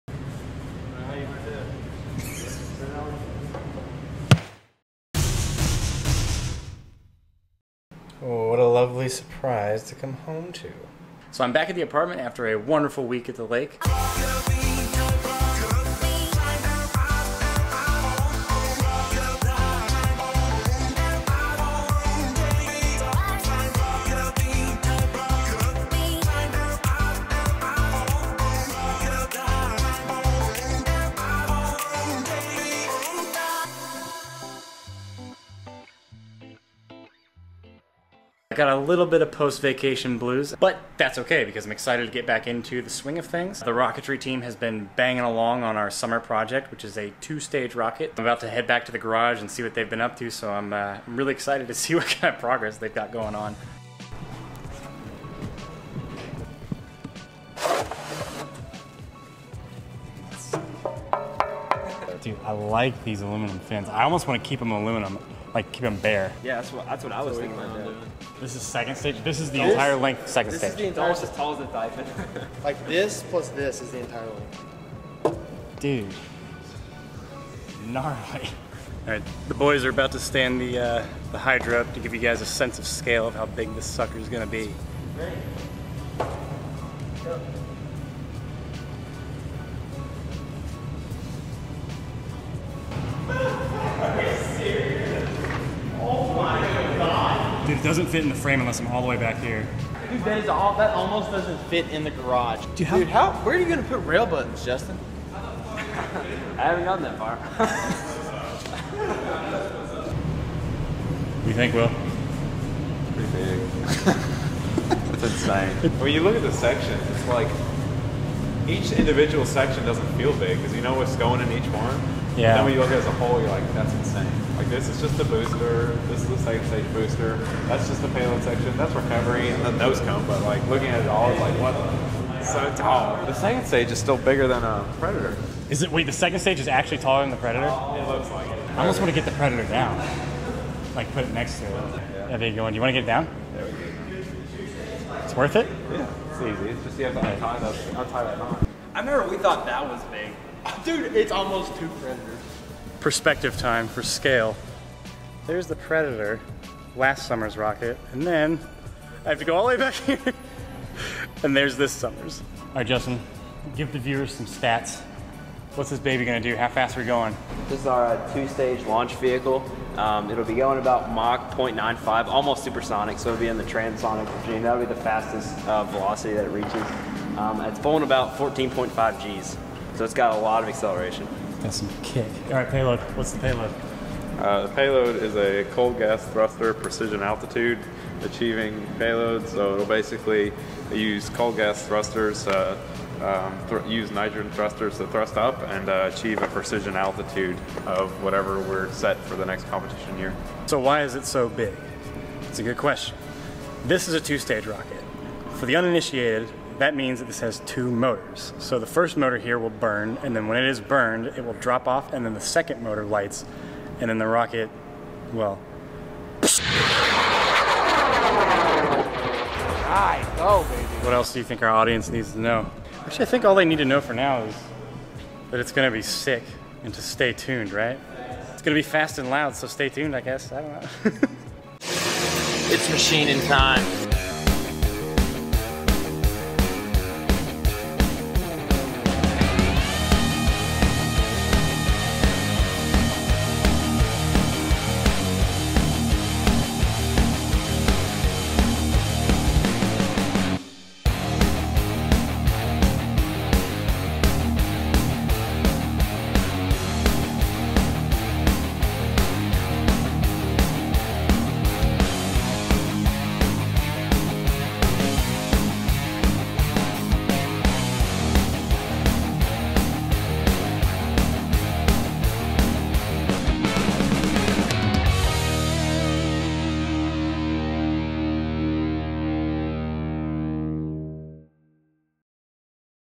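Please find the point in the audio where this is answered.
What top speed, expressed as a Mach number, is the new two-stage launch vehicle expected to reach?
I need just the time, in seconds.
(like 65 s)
171 s.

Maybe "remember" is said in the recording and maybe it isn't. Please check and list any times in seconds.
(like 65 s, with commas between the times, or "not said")
148 s.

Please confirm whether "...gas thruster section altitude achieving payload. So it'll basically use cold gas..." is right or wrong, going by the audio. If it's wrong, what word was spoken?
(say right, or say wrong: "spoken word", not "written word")
wrong: "precision", not "section".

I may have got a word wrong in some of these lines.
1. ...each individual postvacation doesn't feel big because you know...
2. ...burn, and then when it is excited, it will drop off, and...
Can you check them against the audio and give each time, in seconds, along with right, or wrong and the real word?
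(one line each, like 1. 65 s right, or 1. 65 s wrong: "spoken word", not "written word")
1. 118 s wrong: "section", not "postvacation"
2. 209 s wrong: "burned", not "excited".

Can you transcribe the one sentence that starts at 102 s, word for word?
Dude, Dude, how where are you gonna put rail buttons, Justin?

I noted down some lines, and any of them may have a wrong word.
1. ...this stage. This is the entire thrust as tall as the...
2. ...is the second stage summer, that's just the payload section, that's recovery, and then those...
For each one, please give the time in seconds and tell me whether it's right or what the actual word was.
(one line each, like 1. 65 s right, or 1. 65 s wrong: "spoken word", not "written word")
1. 70 s wrong: "almost", not "thrust"
2. 126 s wrong: "booster", not "summer".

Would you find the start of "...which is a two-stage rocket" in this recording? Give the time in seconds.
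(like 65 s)
46 s.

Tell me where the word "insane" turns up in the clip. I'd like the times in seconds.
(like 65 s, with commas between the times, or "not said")
115 s, 123 s.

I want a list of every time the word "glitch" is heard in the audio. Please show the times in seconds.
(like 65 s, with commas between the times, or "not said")
not said.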